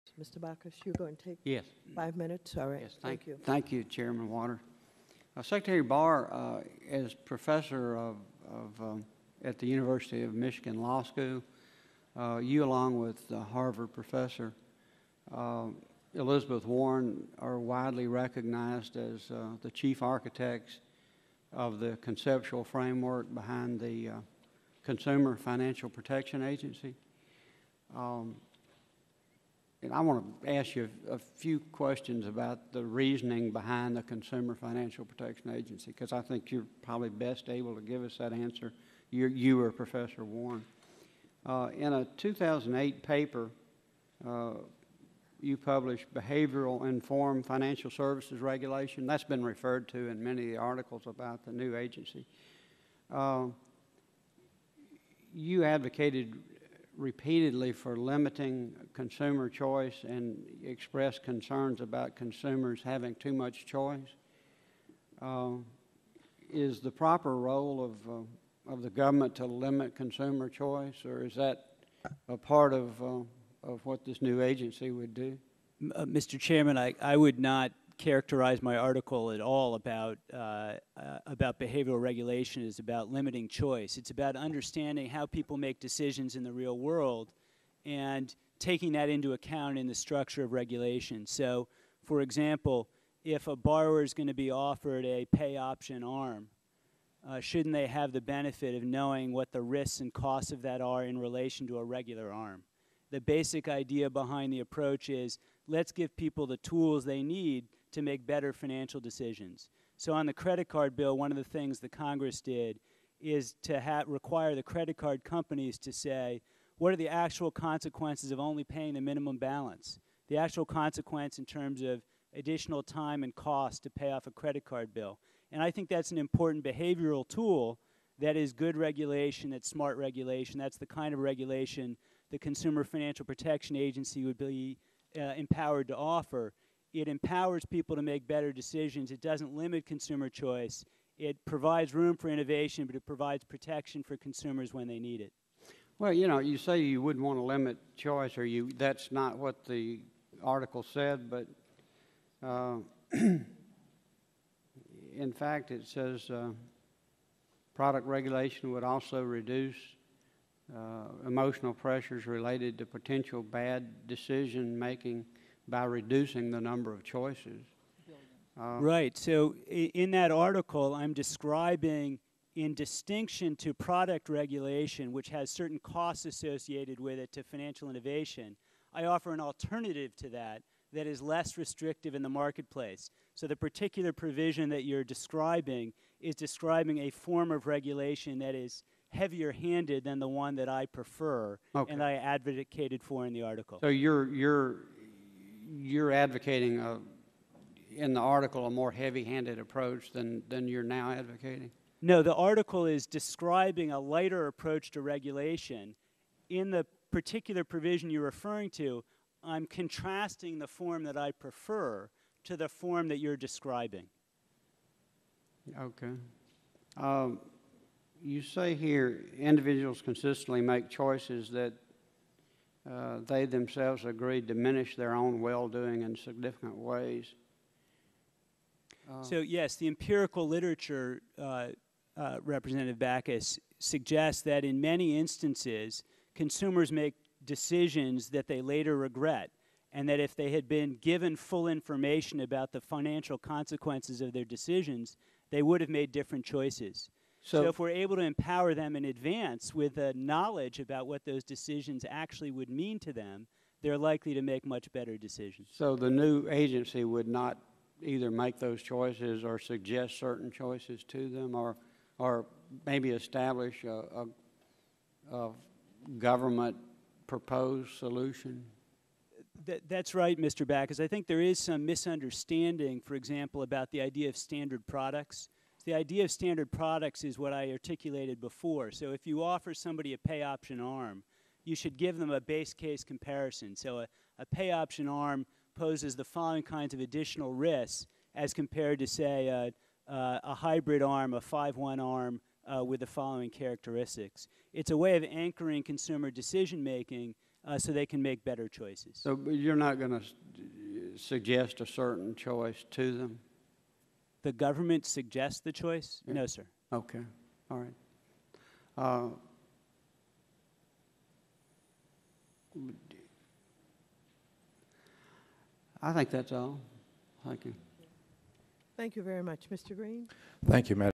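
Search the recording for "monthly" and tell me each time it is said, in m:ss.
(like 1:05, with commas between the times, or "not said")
not said.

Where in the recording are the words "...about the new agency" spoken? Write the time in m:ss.
0:51.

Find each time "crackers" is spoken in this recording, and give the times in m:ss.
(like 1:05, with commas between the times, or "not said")
not said.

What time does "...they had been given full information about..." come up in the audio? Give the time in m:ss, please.
4:00.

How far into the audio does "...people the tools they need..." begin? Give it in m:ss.
1:46.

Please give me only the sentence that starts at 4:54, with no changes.
It's a way of anchoring consumer decision making uh, so they can make better choices.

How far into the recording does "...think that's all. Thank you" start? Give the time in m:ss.
5:16.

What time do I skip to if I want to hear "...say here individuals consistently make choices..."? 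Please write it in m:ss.
3:38.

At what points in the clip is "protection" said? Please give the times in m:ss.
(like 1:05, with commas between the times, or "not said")
0:25, 0:35, 2:13, 2:23.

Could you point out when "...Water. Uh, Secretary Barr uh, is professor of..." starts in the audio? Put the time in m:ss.
0:04.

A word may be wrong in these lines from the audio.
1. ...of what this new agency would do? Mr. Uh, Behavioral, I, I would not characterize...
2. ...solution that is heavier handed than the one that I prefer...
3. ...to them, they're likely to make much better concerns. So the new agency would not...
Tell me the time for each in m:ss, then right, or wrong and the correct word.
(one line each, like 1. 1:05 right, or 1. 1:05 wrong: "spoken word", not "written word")
1. 1:13 wrong: "Chairman", not "Behavioral"
2. 3:07 wrong: "regulation", not "solution"
3. 4:12 wrong: "decisions", not "concerns".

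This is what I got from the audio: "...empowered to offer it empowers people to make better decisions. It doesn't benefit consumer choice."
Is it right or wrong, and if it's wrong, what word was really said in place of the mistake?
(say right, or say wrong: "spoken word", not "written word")
wrong: "limit", not "benefit".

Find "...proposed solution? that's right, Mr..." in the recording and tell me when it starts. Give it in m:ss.
4:27.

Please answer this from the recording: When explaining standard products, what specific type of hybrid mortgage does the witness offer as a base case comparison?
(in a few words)
5-1 ARM.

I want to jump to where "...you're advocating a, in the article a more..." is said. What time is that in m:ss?
3:15.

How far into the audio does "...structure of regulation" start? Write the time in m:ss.
1:29.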